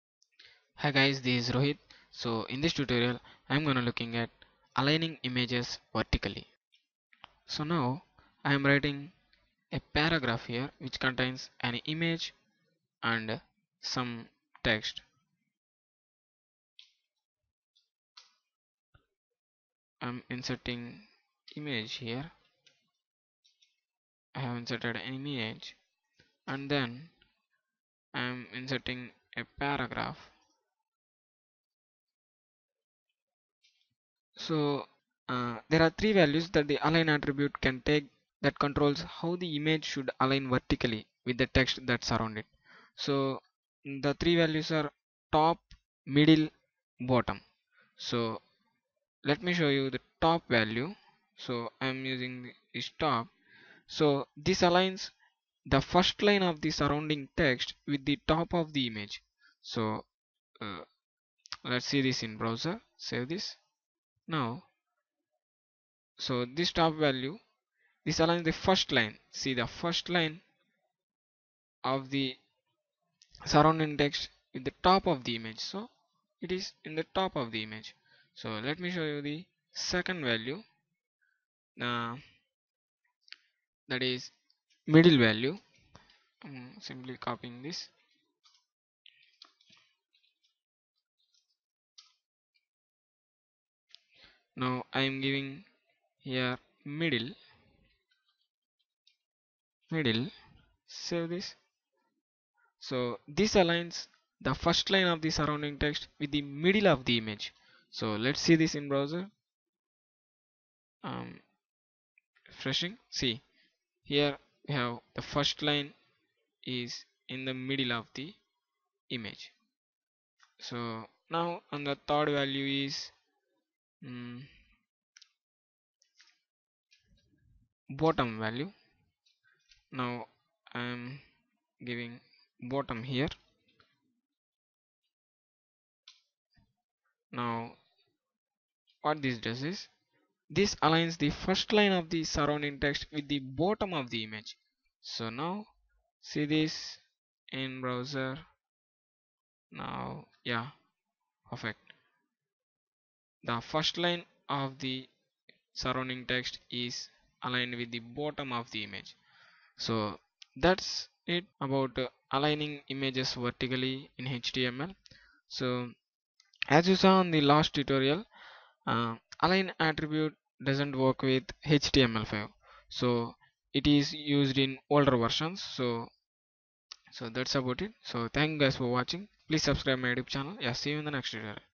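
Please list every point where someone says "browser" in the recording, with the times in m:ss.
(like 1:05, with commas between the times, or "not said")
1:02, 1:48, 2:27.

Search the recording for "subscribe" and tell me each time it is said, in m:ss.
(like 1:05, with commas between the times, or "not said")
2:59.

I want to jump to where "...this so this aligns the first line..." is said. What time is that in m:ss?
1:41.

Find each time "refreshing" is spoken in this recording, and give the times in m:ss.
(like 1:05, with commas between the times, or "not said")
1:52.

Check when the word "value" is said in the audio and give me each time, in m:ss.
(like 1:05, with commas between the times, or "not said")
0:36, 0:44, 0:50, 1:07, 1:20, 1:25, 2:02, 2:08.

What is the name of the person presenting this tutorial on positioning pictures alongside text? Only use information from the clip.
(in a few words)
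Rohit.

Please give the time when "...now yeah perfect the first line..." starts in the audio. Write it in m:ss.
2:29.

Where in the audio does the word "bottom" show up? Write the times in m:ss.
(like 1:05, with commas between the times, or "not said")
0:47, 2:07, 2:12, 2:23, 2:37.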